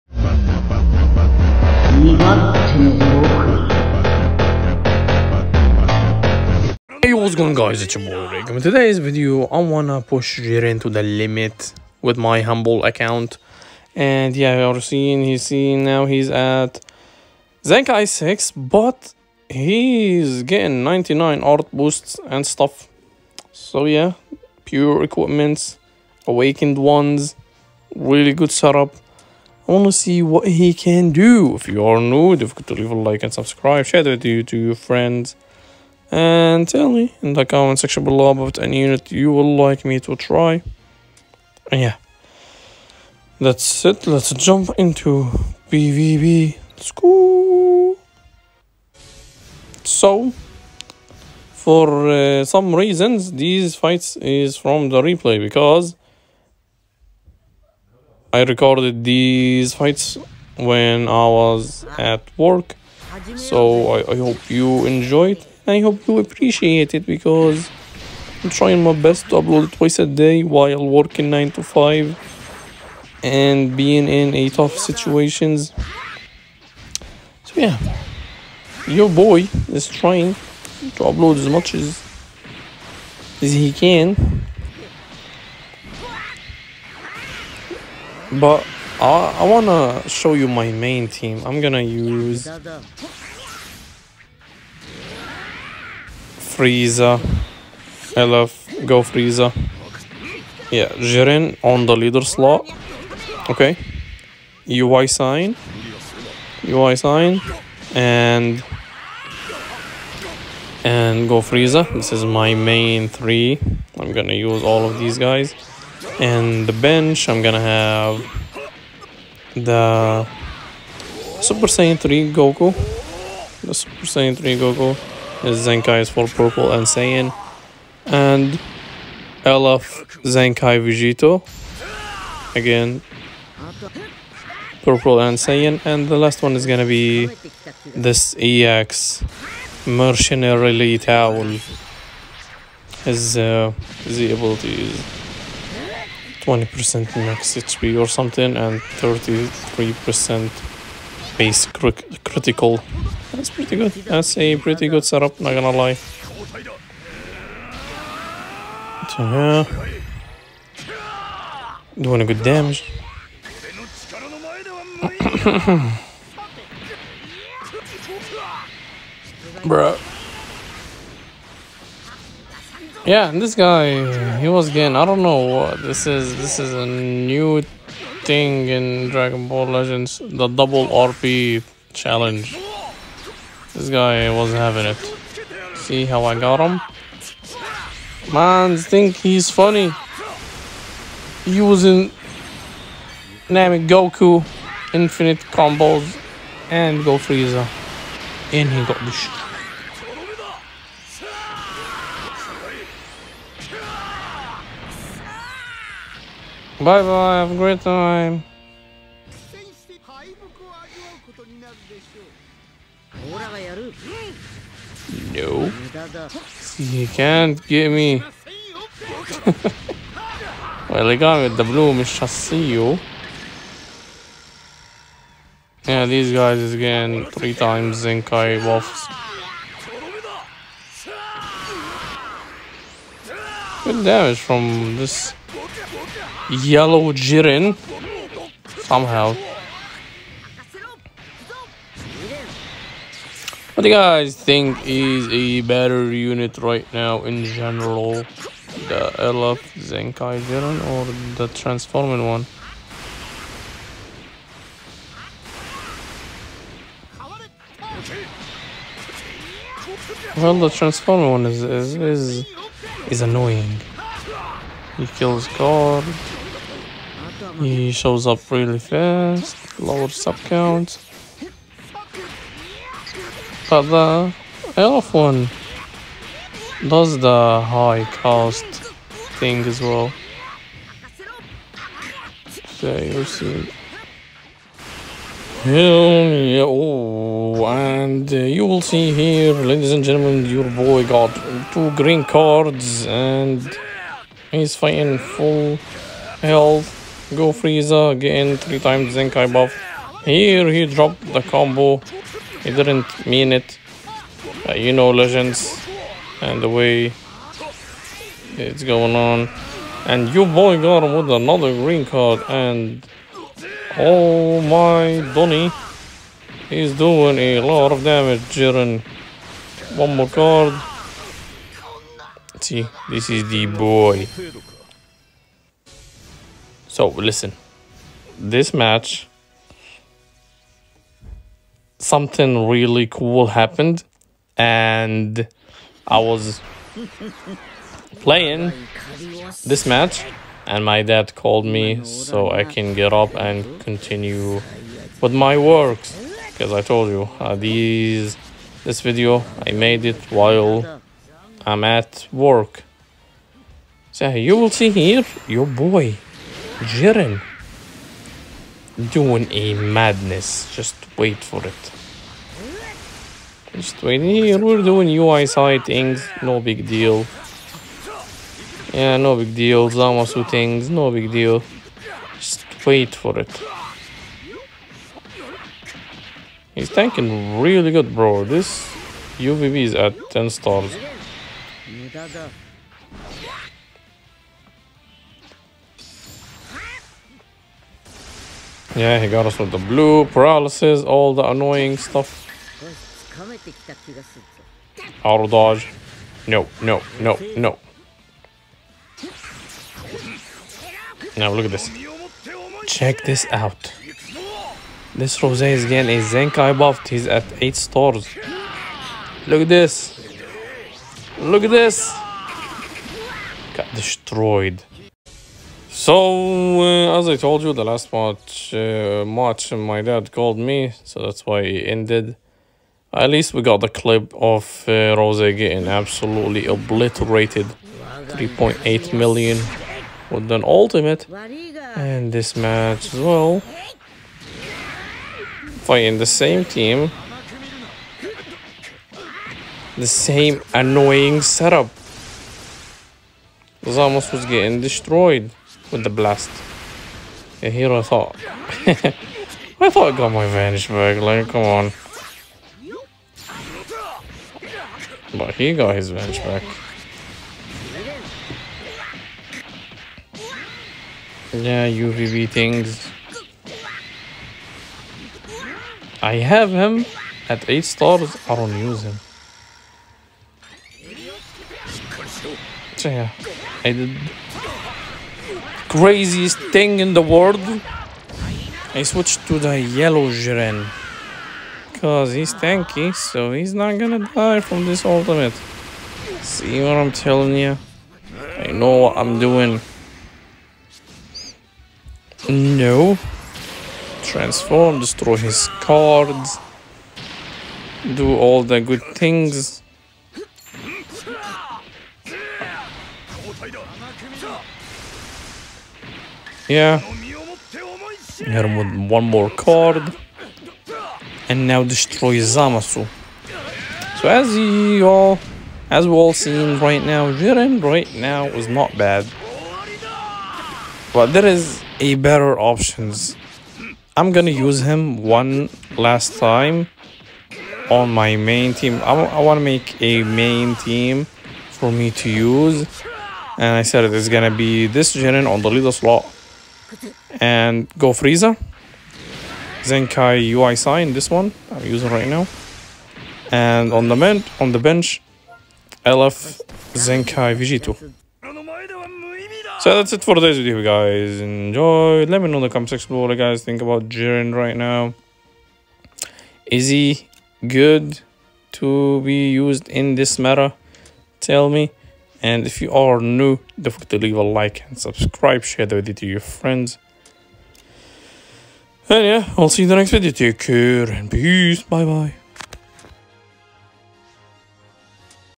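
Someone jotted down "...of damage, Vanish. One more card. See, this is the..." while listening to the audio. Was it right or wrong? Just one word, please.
wrong.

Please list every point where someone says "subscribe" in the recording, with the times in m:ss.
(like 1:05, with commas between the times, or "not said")
0:33, 9:24.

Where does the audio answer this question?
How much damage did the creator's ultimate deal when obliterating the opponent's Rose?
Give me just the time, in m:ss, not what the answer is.
7:08.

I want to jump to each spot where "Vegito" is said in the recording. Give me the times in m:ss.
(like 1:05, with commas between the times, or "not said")
2:10, 9:07.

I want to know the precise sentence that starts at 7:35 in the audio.
But he got his Vanish back.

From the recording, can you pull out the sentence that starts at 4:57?
Go Frieza again, three times Zenkai buff.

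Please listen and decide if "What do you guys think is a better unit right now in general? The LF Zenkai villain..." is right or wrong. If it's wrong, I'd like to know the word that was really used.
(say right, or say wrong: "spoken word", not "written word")
right.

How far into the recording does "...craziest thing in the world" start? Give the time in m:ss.
7:55.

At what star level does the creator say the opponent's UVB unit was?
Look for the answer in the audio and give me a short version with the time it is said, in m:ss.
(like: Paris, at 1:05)
10 stars, at 6:20.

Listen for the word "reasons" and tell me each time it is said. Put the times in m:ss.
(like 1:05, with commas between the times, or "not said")
0:52.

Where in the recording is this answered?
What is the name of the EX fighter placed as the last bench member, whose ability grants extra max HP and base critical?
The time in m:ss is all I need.
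2:18.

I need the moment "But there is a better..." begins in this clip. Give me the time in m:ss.
8:41.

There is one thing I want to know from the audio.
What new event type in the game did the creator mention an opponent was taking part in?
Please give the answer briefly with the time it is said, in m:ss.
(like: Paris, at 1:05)
double RP challenge, at 3:00.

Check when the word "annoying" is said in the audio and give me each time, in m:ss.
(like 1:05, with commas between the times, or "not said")
4:23, 6:31, 7:20.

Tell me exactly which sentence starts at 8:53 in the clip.
And I said it's gonna be this Jiren on the leader slot and go Frieza.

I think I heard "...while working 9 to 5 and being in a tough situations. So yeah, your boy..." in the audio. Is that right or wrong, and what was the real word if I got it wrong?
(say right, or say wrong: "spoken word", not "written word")
right.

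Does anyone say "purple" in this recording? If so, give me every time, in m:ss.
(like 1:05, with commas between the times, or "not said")
2:06, 2:14.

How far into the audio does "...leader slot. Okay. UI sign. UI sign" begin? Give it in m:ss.
1:41.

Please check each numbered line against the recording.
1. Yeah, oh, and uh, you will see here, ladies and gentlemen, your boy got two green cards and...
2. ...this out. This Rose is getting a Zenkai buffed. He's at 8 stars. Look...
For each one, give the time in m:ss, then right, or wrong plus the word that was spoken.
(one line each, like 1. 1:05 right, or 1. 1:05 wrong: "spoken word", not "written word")
1. 4:45 right
2. 6:43 right.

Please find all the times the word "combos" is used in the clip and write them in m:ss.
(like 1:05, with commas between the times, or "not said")
3:15, 5:01.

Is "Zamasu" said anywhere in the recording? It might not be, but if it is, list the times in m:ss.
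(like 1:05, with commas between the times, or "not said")
6:09, 8:32.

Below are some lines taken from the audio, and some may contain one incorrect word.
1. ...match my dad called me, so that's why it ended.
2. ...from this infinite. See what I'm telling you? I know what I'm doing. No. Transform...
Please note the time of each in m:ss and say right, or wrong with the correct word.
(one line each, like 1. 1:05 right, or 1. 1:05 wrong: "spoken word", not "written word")
1. 6:59 right
2. 8:04 wrong: "ultimate", not "infinite".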